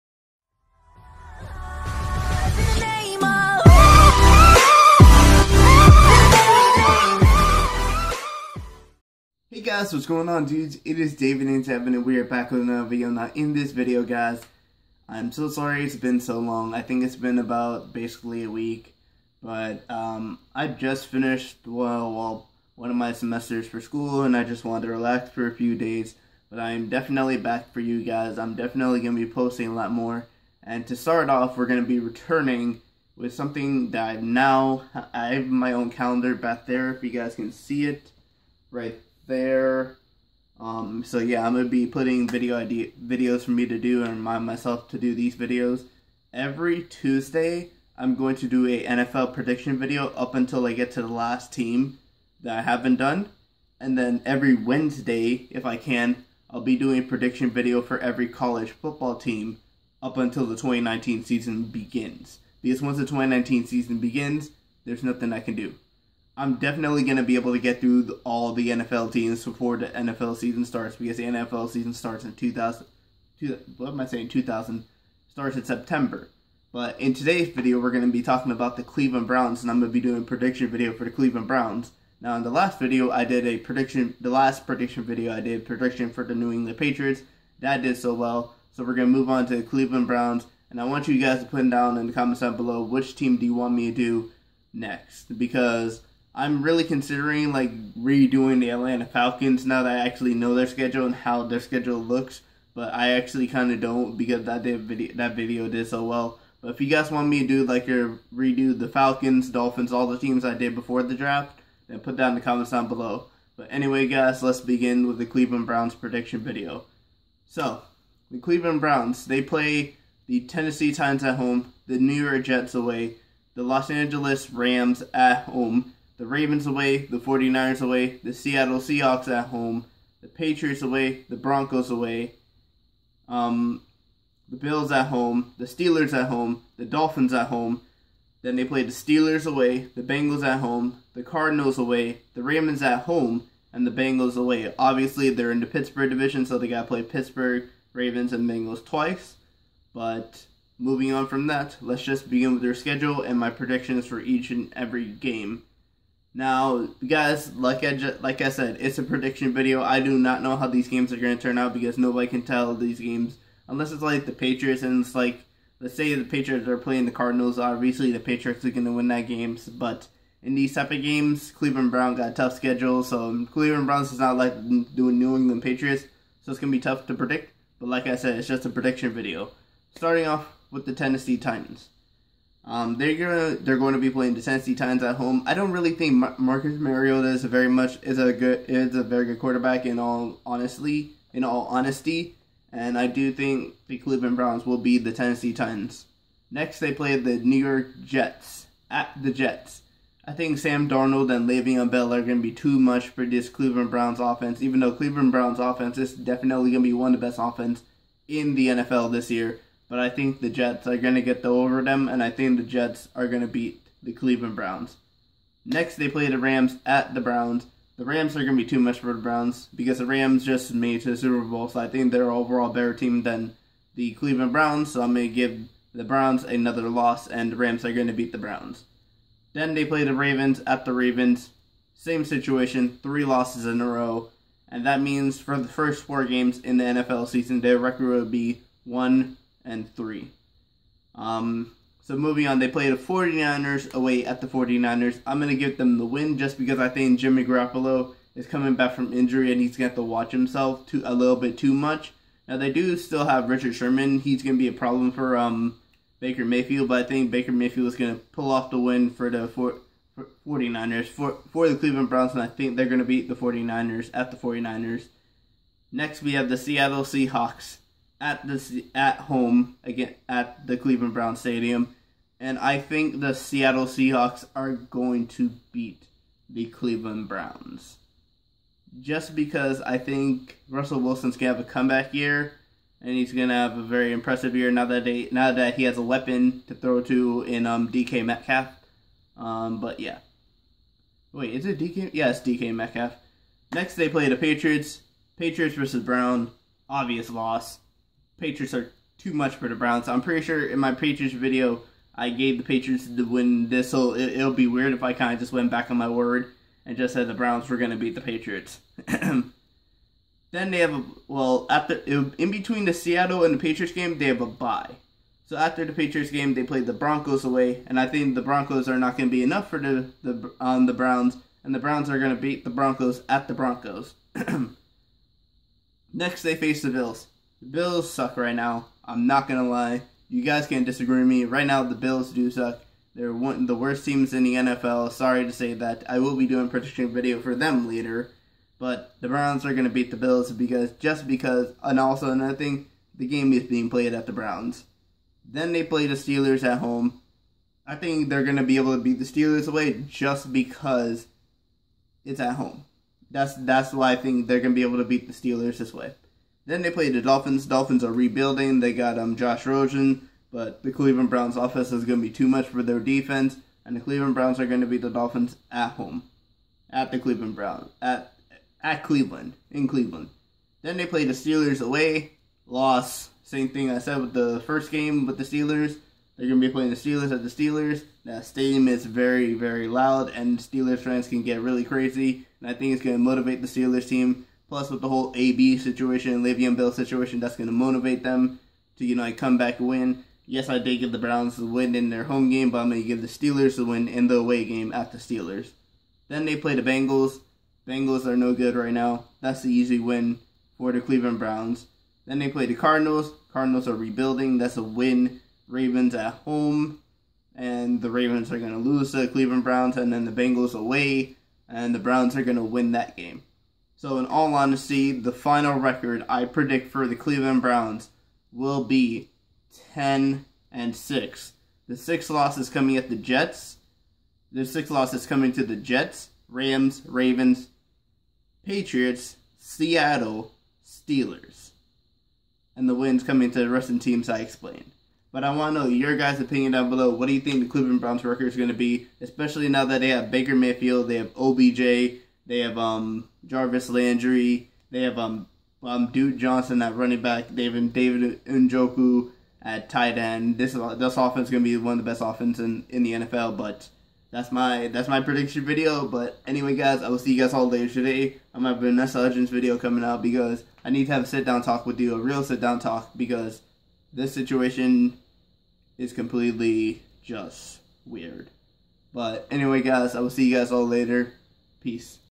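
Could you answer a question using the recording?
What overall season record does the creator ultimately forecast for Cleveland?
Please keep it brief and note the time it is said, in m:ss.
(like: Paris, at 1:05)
10 and 6, at 6:59.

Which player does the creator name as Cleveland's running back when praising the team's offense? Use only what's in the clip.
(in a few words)
Duke Johnson.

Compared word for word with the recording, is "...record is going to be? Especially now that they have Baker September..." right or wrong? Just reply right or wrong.
wrong.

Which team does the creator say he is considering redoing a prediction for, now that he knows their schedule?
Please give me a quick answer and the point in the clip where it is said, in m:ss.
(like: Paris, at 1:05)
Atlanta Falcons, at 1:38.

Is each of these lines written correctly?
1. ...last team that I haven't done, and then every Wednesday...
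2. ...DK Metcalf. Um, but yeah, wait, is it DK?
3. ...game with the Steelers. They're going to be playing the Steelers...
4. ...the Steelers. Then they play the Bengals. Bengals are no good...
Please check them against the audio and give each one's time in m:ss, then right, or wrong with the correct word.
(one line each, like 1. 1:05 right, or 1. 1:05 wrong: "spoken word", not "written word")
1. 0:51 right
2. 4:47 right
3. 6:14 right
4. 6:35 right.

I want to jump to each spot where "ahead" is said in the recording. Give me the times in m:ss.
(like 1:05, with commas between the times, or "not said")
not said.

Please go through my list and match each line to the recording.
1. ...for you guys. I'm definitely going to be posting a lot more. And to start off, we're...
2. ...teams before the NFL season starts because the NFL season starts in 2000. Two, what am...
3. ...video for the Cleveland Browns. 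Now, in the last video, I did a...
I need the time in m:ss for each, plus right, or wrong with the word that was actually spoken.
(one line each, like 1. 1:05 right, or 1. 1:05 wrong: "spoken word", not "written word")
1. 0:27 right
2. 1:09 right
3. 1:20 right.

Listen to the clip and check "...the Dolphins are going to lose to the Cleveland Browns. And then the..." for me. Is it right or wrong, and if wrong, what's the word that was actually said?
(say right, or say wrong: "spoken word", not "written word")
wrong: "Ravens", not "Dolphins".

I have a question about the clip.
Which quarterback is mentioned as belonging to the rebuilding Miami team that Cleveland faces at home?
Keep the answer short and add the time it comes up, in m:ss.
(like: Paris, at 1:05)
Josh Rosen, at 5:59.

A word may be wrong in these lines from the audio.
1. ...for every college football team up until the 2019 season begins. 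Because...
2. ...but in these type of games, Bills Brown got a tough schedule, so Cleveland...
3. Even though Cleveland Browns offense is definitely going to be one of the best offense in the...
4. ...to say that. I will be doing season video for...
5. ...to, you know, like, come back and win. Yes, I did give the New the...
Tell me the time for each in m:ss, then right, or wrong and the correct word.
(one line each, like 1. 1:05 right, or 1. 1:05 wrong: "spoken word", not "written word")
1. 0:57 right
2. 2:49 wrong: "Cleveland", not "Bills"
3. 3:24 right
4. 5:35 wrong: "prediction", not "season"
5. 6:28 wrong: "Browns", not "New".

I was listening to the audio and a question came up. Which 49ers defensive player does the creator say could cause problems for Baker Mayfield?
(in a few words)
Richard Sherman.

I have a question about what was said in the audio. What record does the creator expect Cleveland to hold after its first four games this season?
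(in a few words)
1 and 3.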